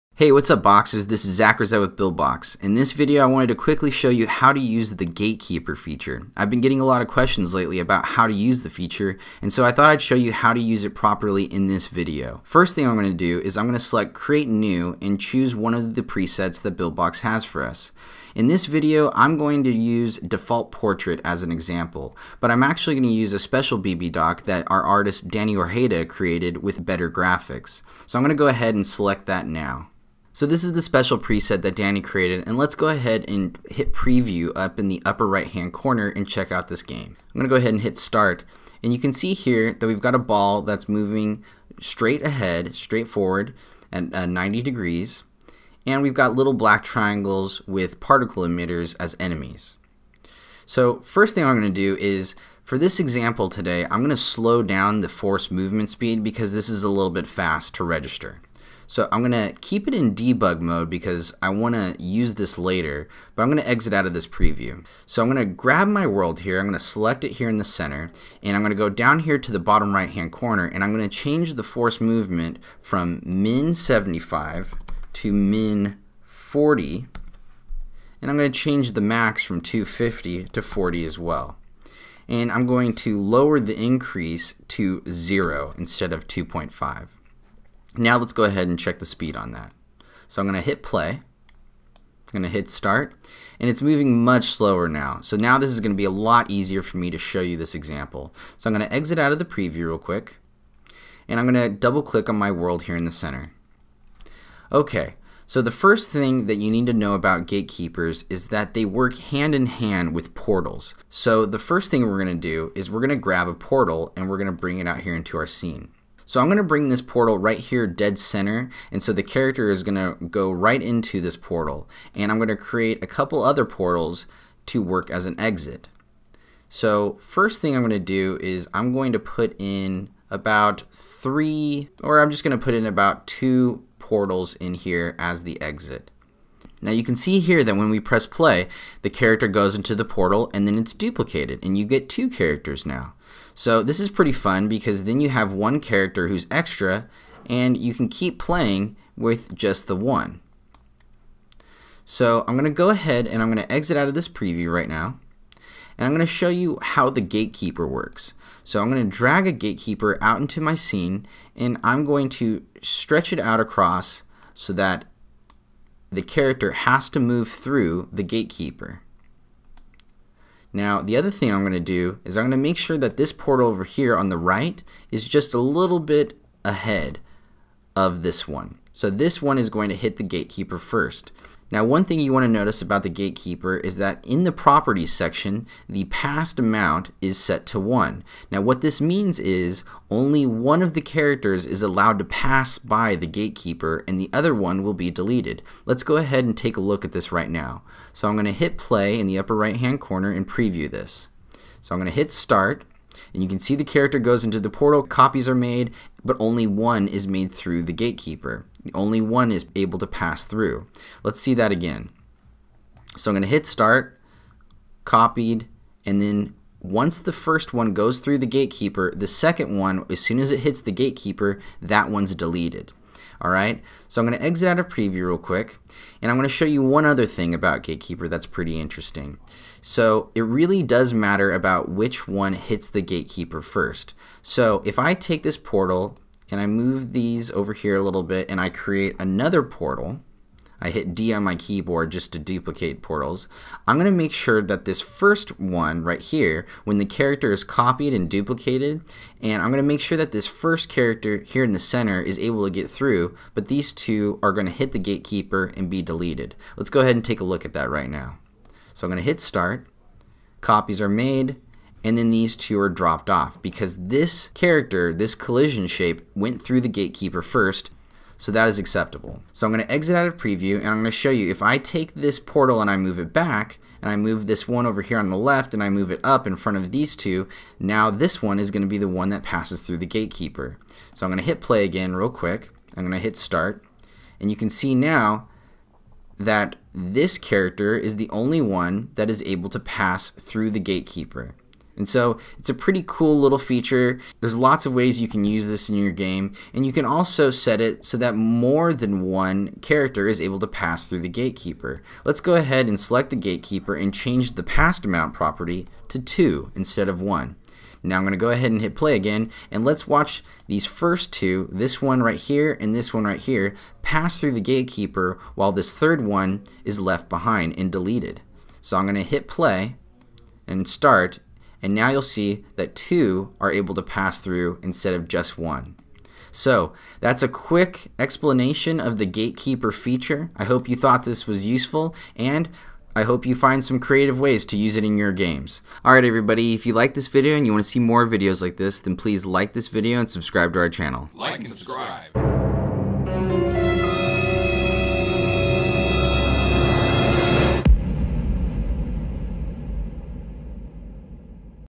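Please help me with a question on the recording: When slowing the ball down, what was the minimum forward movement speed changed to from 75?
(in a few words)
40.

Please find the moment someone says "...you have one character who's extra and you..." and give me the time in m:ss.
2:25.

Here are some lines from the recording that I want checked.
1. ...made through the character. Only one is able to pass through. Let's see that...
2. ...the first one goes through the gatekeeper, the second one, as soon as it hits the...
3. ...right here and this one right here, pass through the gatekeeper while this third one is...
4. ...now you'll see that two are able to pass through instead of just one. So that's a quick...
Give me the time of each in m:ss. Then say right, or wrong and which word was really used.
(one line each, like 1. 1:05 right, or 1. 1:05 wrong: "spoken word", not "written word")
1. 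3:27 wrong: "gatekeeper", not "character"
2. 3:37 right
3. 5:12 right
4. 5:21 right.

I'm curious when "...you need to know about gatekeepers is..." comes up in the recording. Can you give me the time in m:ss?
1:46.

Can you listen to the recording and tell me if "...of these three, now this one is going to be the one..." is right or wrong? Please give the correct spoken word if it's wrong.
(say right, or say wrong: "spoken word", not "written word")
wrong: "two", not "three".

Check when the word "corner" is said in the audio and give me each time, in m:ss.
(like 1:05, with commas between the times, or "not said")
0:35, 1:10, 3:20.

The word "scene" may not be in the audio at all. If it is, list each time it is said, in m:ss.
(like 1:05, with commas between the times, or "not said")
1:55, 2:40.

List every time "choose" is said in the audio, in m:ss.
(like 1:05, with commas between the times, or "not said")
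0:15.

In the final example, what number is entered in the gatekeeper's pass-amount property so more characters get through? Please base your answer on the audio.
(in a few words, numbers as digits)
2.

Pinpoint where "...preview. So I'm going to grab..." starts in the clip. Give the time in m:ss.
1:04.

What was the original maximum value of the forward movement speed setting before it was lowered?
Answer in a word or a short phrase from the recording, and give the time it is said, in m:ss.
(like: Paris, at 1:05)
250, at 1:19.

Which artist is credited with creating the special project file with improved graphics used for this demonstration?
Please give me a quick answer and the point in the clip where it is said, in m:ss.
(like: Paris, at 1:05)
Danny Orjeda, at 0:25.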